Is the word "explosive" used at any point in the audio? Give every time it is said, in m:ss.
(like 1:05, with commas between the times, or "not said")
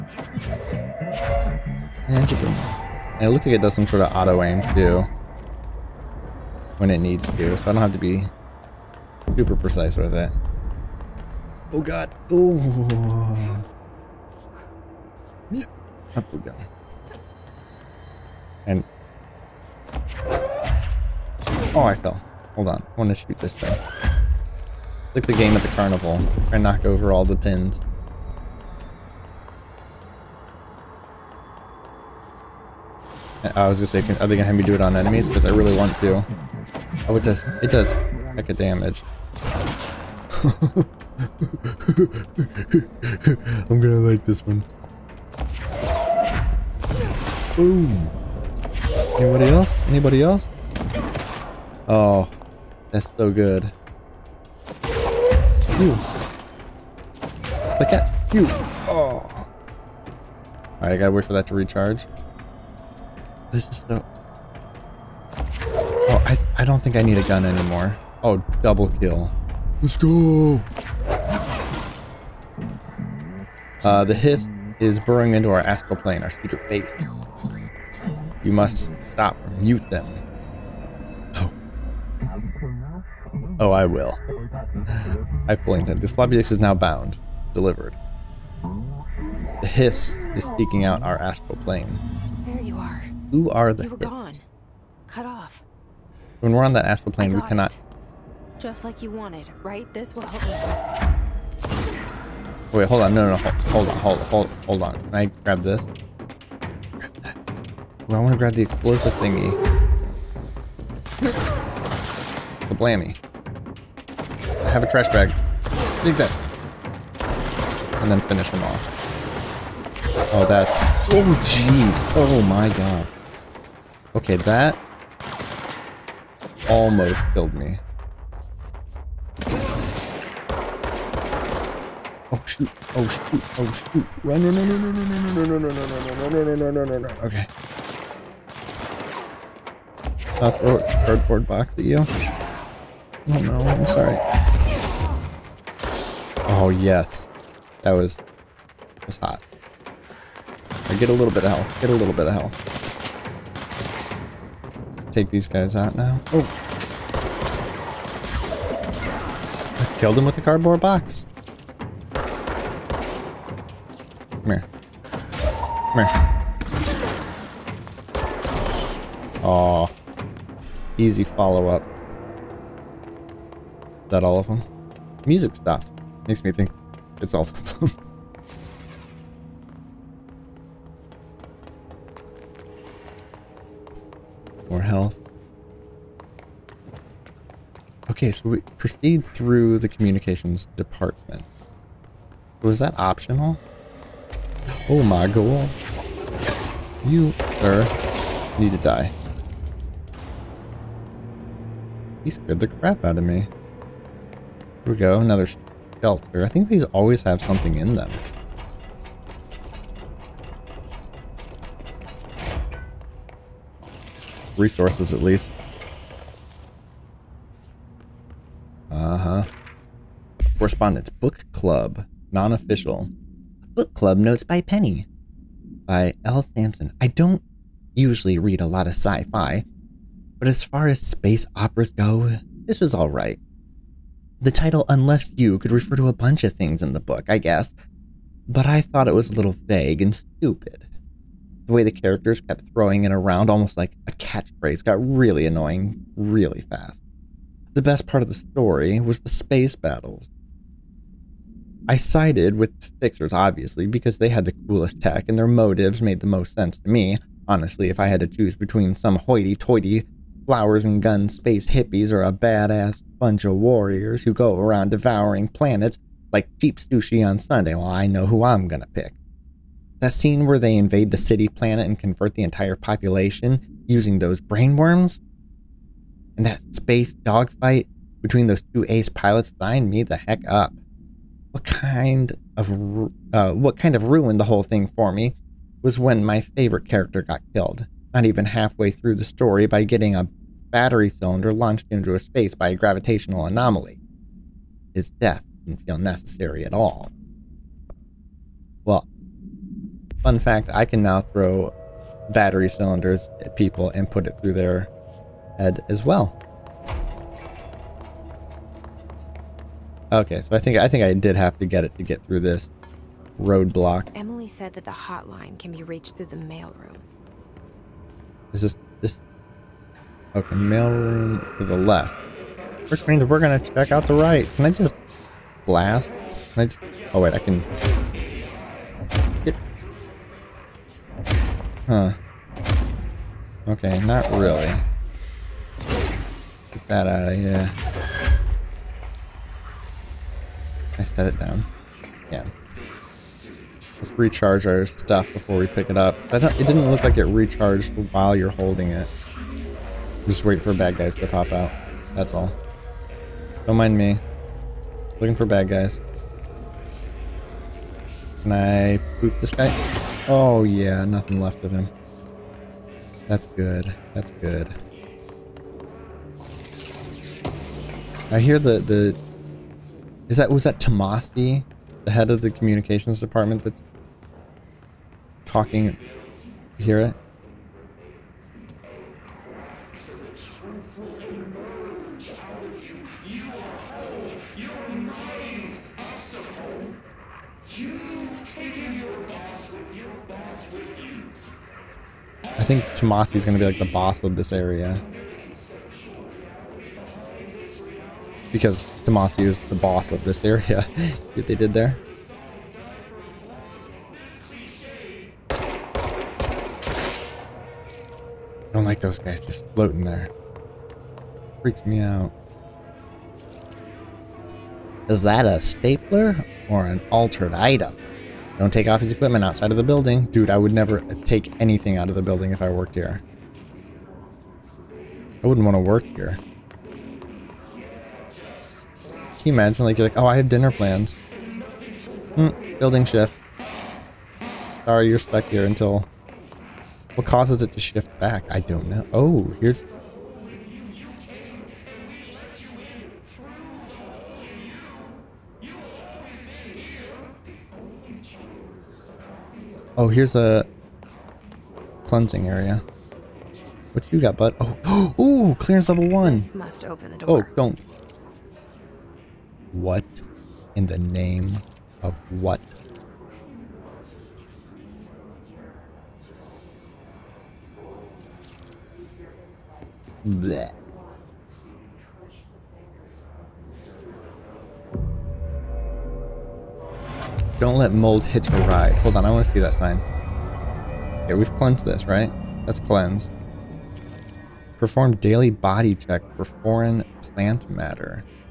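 1:48.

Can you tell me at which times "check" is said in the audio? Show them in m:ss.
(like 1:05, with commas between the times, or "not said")
5:23, 8:05.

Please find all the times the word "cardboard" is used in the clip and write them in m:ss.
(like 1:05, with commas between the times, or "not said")
2:21, 2:40.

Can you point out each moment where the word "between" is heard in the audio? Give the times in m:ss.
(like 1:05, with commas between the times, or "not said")
4:18, 4:38.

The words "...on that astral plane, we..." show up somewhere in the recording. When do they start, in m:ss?
1:36.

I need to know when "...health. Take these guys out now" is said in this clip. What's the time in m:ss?
2:32.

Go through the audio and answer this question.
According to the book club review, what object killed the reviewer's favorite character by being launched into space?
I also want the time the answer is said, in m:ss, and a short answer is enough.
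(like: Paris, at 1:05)
A battery cylinder, at 4:50.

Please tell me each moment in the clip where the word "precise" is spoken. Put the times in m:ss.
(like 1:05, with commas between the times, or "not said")
0:09.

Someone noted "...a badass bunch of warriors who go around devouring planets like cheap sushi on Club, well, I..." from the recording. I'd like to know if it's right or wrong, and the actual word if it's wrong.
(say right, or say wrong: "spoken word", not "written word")
wrong: "Sunday", not "Club".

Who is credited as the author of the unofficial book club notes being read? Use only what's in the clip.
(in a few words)
L. Sampson.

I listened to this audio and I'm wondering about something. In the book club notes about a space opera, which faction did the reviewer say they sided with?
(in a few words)
The Fixers.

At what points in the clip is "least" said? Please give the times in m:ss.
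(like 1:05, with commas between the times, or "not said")
3:35.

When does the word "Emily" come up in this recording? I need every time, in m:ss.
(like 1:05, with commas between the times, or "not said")
5:14.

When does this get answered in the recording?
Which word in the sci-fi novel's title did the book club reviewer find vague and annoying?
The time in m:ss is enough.
3:54.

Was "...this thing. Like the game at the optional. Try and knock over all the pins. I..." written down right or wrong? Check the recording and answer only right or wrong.
wrong.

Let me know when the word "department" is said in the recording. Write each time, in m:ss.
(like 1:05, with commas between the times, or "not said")
3:10, 6:13.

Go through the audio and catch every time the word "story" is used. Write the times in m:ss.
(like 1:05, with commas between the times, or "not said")
4:08, 4:49.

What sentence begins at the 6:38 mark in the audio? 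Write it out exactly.
because Tommasi is the boss of this area.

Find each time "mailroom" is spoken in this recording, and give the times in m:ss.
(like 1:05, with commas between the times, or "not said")
5:16, 5:20.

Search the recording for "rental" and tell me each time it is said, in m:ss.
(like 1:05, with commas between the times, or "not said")
not said.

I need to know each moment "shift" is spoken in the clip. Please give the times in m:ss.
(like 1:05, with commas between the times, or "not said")
7:13, 7:17.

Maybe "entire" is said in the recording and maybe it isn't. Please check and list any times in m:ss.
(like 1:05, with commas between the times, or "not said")
4:32.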